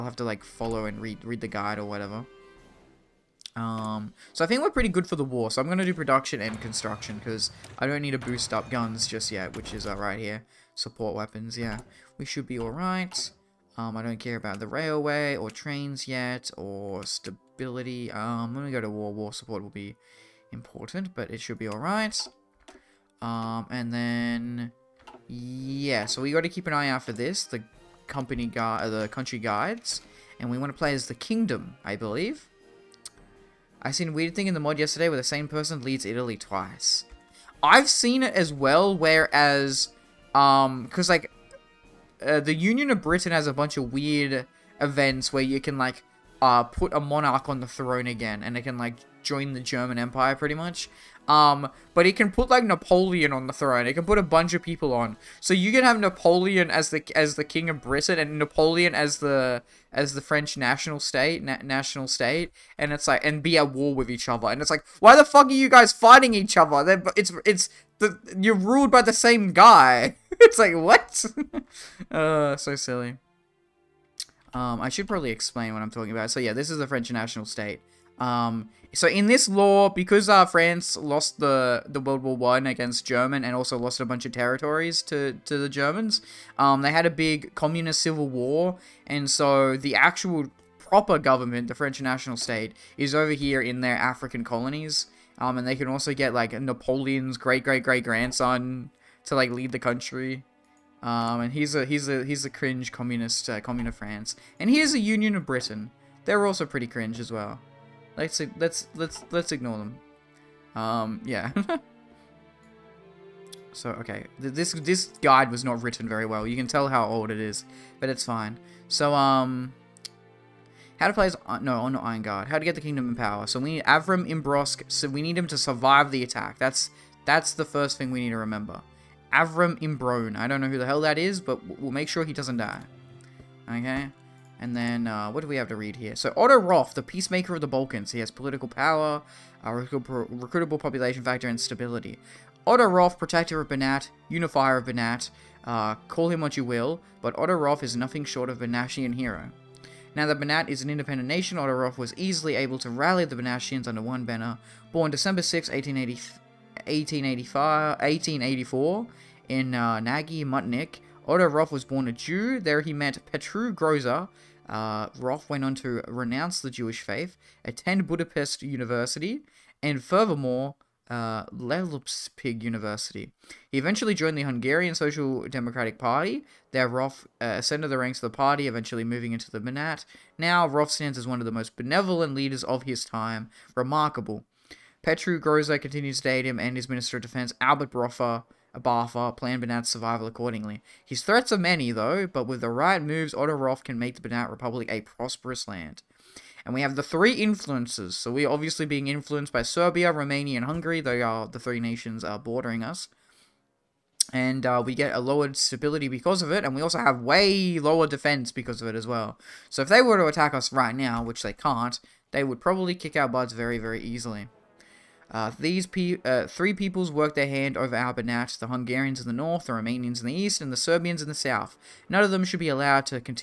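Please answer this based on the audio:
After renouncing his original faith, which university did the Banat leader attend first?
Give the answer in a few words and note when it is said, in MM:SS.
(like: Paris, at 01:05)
Budapest University, at 02:48.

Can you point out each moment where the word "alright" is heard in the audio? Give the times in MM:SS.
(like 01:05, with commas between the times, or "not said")
00:12, 00:21.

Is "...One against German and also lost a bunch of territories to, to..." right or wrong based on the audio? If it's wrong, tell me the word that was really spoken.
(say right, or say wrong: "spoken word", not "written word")
right.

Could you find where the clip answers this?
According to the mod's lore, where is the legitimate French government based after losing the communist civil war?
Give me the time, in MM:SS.
01:33.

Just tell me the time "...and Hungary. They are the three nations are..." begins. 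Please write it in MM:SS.
03:20.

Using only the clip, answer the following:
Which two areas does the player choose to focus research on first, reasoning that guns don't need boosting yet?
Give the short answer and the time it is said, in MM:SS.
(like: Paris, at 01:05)
Production and construction, at 00:05.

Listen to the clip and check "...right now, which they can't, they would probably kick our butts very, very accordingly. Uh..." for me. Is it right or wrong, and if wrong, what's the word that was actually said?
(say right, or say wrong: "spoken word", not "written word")
wrong: "easily", not "accordingly".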